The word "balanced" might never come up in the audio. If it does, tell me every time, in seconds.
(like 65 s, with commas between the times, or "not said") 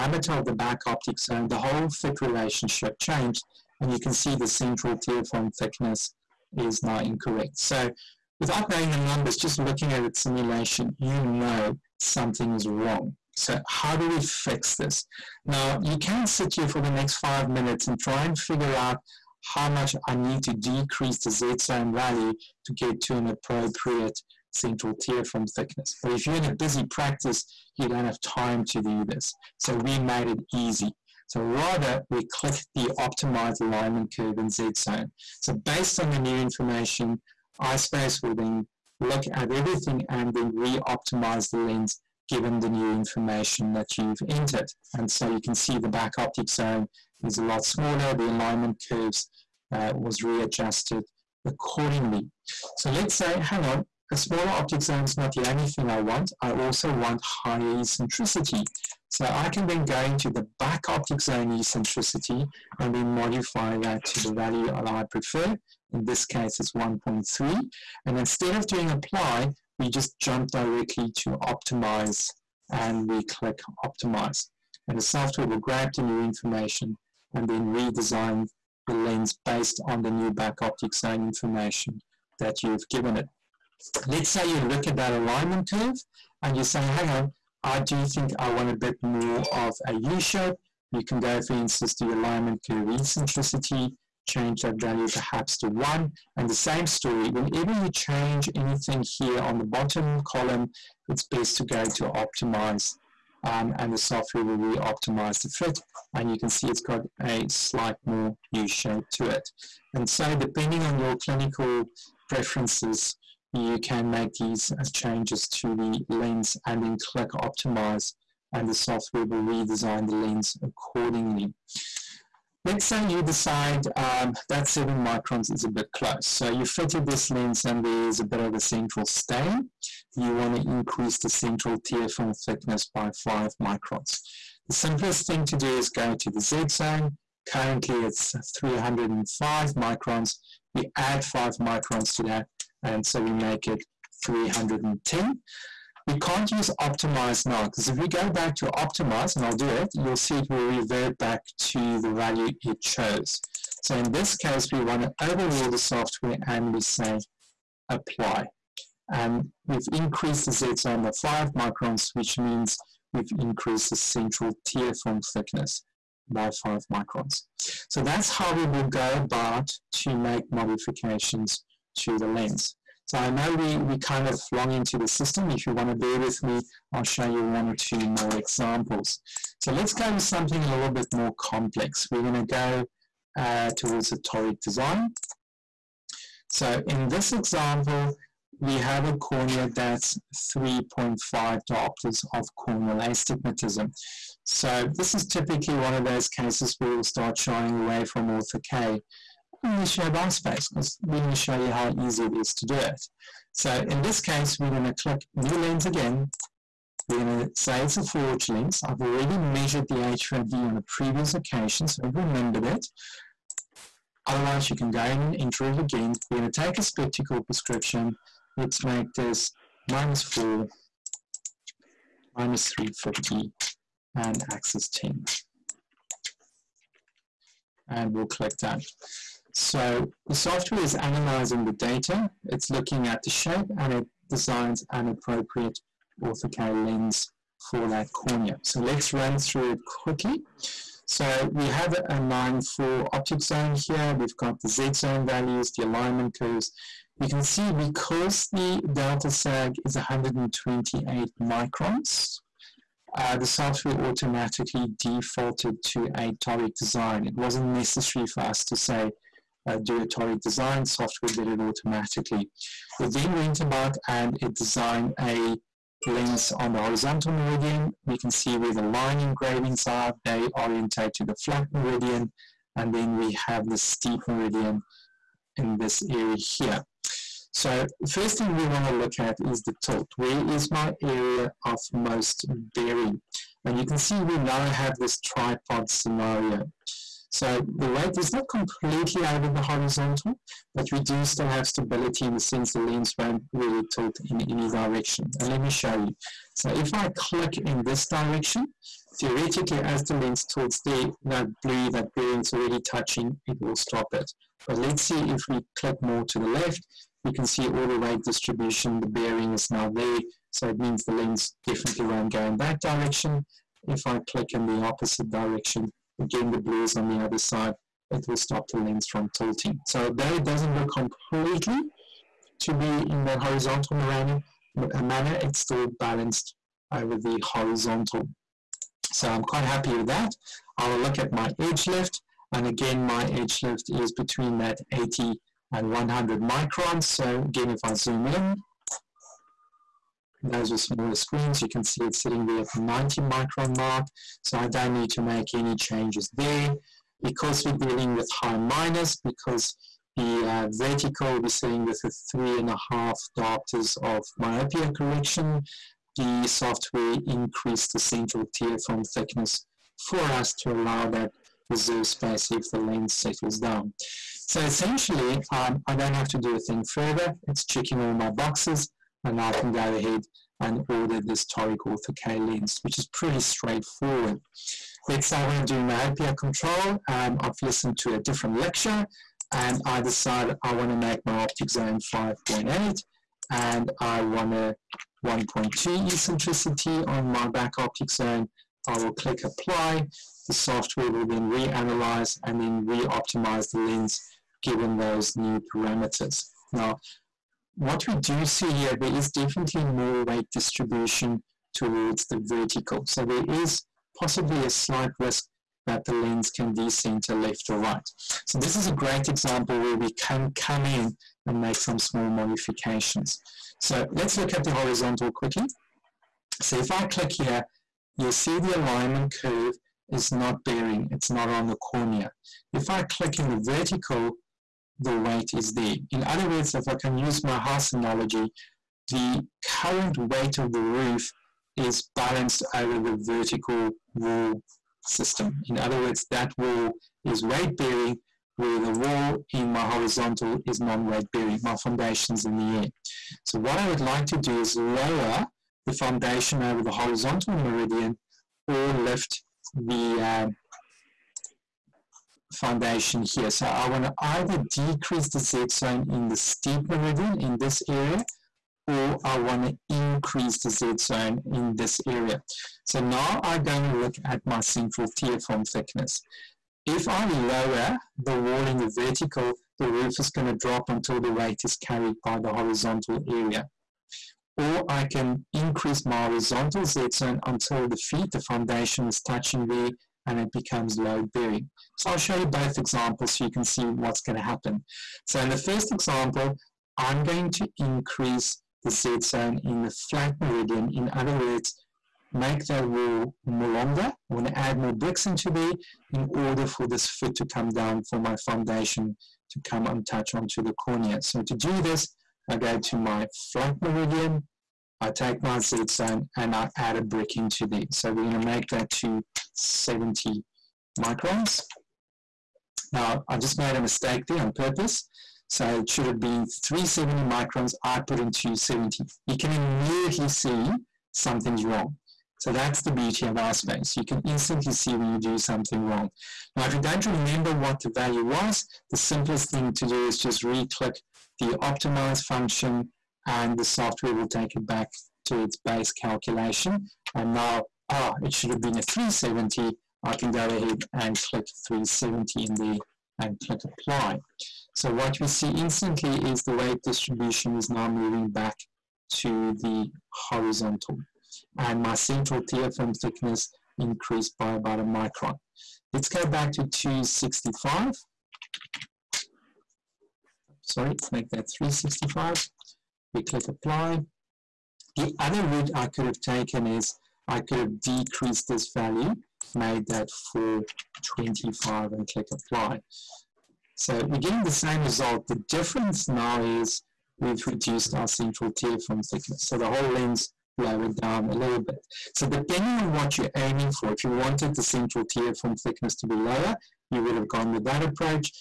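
325 s, 432 s.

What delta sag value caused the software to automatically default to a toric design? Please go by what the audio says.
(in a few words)
128 microns.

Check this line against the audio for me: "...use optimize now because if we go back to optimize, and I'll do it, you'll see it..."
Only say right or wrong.
right.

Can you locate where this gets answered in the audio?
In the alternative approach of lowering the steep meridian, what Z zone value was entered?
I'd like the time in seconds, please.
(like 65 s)
570 s.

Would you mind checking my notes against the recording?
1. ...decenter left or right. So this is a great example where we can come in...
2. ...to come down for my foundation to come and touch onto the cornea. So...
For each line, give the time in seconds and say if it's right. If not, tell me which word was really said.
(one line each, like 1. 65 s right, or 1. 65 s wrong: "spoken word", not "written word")
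1. 406 s right
2. 497 s right.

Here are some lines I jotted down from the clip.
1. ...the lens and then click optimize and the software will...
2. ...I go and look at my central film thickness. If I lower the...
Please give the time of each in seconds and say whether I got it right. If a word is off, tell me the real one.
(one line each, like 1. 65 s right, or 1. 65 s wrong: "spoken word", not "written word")
1. 115 s right
2. 463 s right.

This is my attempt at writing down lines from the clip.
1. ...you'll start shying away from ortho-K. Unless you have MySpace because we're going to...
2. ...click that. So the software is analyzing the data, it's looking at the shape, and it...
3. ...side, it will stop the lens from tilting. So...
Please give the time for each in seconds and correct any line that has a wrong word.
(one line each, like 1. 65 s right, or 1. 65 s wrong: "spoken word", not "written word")
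1. 196 s right
2. 228 s right
3. 317 s right.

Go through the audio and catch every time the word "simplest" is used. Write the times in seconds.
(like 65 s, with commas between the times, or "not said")
134 s, 528 s.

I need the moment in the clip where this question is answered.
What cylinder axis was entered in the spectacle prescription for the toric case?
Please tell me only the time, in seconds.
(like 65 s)
224 s.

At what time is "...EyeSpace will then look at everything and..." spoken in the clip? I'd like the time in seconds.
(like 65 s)
37 s.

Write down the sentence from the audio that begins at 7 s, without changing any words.
So without knowing the numbers, just looking at its simulation, you know something is wrong.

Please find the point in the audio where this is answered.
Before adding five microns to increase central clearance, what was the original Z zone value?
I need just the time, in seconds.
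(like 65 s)
138 s.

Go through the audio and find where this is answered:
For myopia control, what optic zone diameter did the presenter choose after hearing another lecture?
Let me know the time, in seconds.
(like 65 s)
382 s.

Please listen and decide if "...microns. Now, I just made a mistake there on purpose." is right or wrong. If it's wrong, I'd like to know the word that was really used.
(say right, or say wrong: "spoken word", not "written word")
right.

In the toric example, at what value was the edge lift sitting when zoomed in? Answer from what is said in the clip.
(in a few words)
90 microns.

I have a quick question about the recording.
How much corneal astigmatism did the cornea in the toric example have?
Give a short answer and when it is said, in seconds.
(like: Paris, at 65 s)
3.5 diopters, at 190 s.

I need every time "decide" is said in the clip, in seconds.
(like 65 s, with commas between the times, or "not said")
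123 s, 380 s.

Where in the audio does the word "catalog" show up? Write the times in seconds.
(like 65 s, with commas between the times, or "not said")
not said.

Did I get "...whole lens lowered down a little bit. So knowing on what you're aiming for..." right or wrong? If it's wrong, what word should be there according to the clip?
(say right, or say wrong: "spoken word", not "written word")
wrong: "depending", not "knowing".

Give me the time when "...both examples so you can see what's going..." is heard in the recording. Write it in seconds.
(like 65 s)
482 s.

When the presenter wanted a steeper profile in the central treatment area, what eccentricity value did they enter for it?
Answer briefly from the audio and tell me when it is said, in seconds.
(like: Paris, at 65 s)
1.3, at 66 s.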